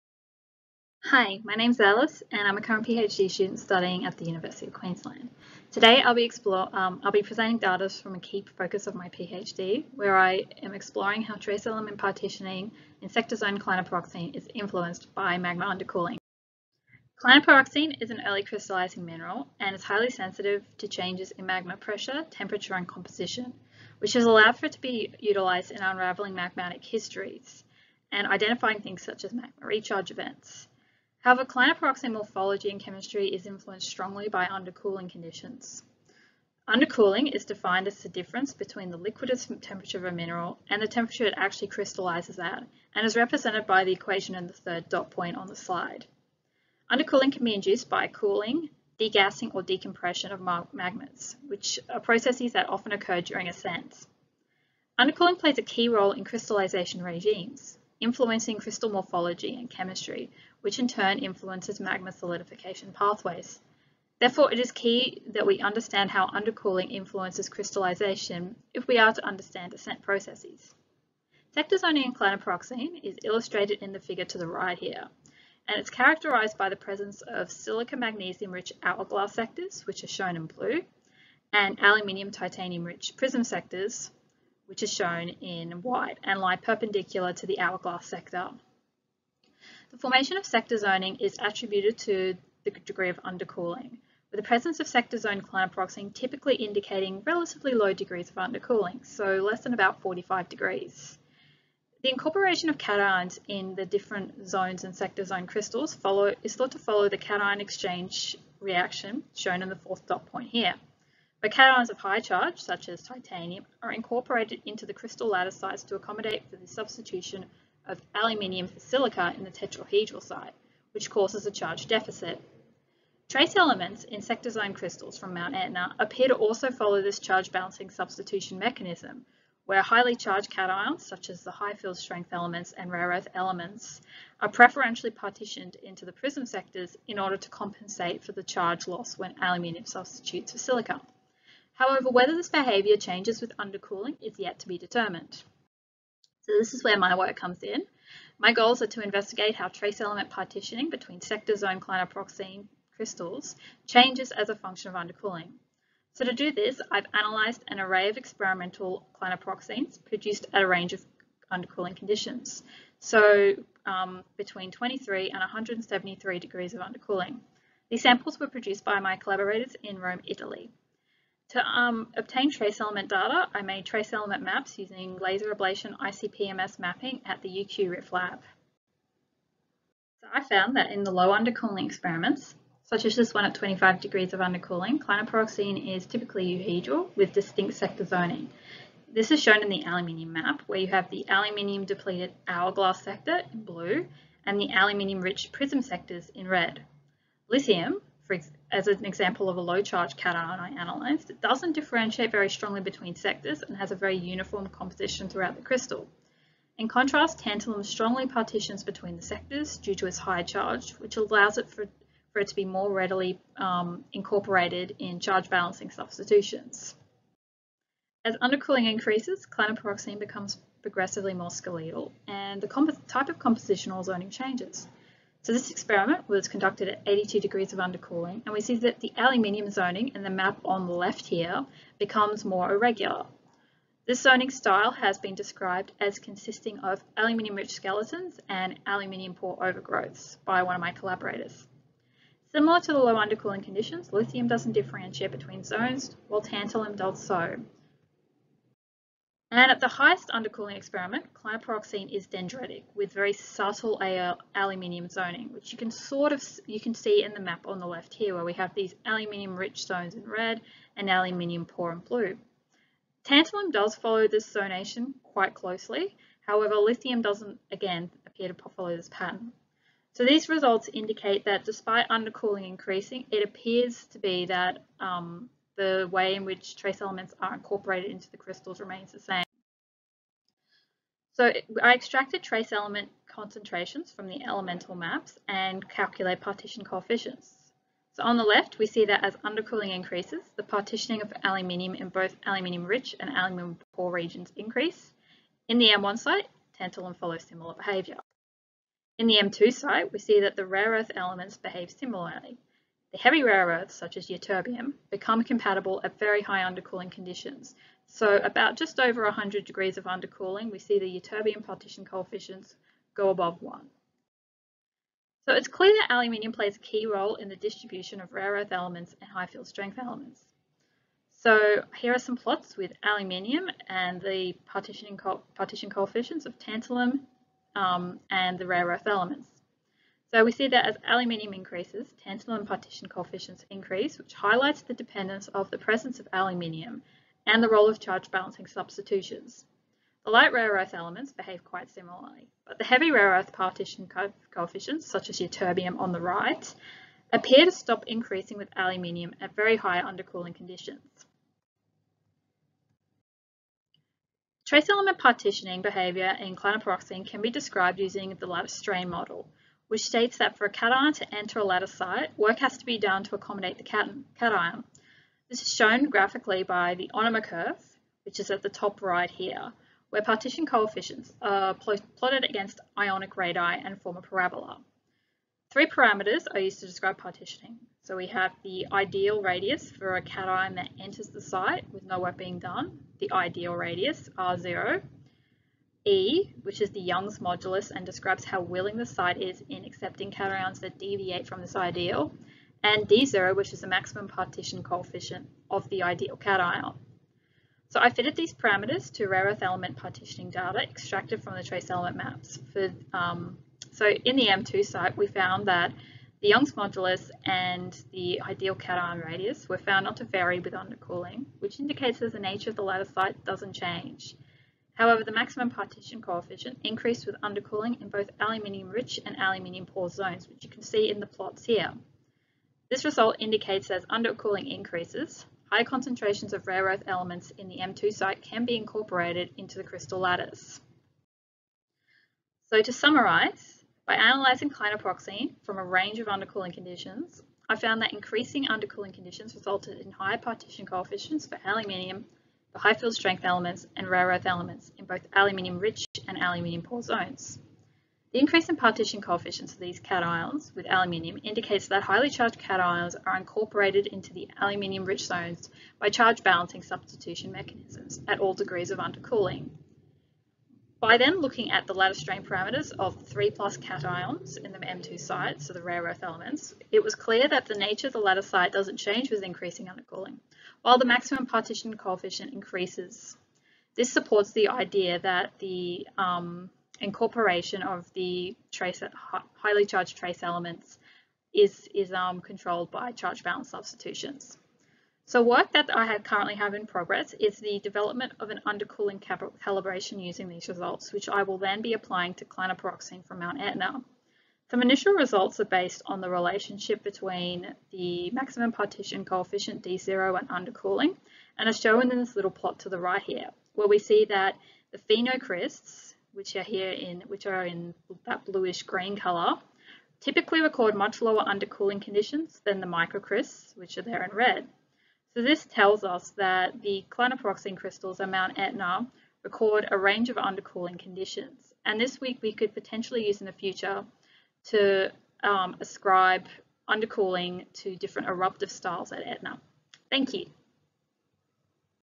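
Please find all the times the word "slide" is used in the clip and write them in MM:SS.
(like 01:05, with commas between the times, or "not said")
00:45.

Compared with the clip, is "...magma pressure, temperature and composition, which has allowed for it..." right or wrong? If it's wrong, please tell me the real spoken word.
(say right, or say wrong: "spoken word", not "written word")
right.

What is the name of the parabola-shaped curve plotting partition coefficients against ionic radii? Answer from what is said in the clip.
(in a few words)
Onuma curve.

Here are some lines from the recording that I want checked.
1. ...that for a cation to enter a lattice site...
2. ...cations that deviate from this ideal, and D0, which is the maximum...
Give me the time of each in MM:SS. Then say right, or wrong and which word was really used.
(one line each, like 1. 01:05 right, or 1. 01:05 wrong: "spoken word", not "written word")
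1. 06:00 right
2. 06:30 right.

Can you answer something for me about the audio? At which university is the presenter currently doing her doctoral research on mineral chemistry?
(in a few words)
University of Queensland.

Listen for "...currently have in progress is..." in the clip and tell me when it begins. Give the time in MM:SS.
08:06.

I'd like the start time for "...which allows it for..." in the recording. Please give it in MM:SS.
03:30.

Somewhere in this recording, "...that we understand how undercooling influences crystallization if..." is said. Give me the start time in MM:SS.
01:05.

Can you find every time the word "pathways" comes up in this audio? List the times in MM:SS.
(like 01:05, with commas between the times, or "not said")
01:02.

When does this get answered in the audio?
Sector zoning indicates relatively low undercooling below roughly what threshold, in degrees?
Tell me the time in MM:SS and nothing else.
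01:40.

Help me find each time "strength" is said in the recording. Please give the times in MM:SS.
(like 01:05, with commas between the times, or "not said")
02:11, 05:19, 07:23.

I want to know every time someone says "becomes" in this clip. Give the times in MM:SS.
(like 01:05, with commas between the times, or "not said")
03:40, 03:51, 05:05.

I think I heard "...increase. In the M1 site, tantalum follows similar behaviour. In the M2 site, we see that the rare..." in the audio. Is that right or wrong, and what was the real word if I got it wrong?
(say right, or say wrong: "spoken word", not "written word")
right.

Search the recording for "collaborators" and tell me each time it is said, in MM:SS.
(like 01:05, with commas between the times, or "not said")
02:49, 04:00.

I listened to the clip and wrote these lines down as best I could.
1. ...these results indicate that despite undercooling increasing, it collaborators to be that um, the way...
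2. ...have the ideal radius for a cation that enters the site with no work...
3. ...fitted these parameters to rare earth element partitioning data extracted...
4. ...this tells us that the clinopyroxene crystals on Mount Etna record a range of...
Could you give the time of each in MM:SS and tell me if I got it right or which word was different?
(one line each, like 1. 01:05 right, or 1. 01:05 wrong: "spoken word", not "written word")
1. 04:30 wrong: "appears", not "collaborators"
2. 06:18 right
3. 06:38 right
4. 08:35 right.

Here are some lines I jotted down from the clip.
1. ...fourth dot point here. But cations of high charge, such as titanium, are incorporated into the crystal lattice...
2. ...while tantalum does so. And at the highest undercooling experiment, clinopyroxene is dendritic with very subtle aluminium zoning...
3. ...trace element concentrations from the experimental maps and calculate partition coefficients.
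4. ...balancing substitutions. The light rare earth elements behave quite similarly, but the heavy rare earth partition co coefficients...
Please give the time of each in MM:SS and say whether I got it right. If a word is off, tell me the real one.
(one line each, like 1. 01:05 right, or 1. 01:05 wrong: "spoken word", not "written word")
1. 01:49 right
2. 04:06 right
3. 04:42 wrong: "elemental", not "experimental"
4. 05:38 right.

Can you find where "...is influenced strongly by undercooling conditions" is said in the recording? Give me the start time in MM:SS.
00:33.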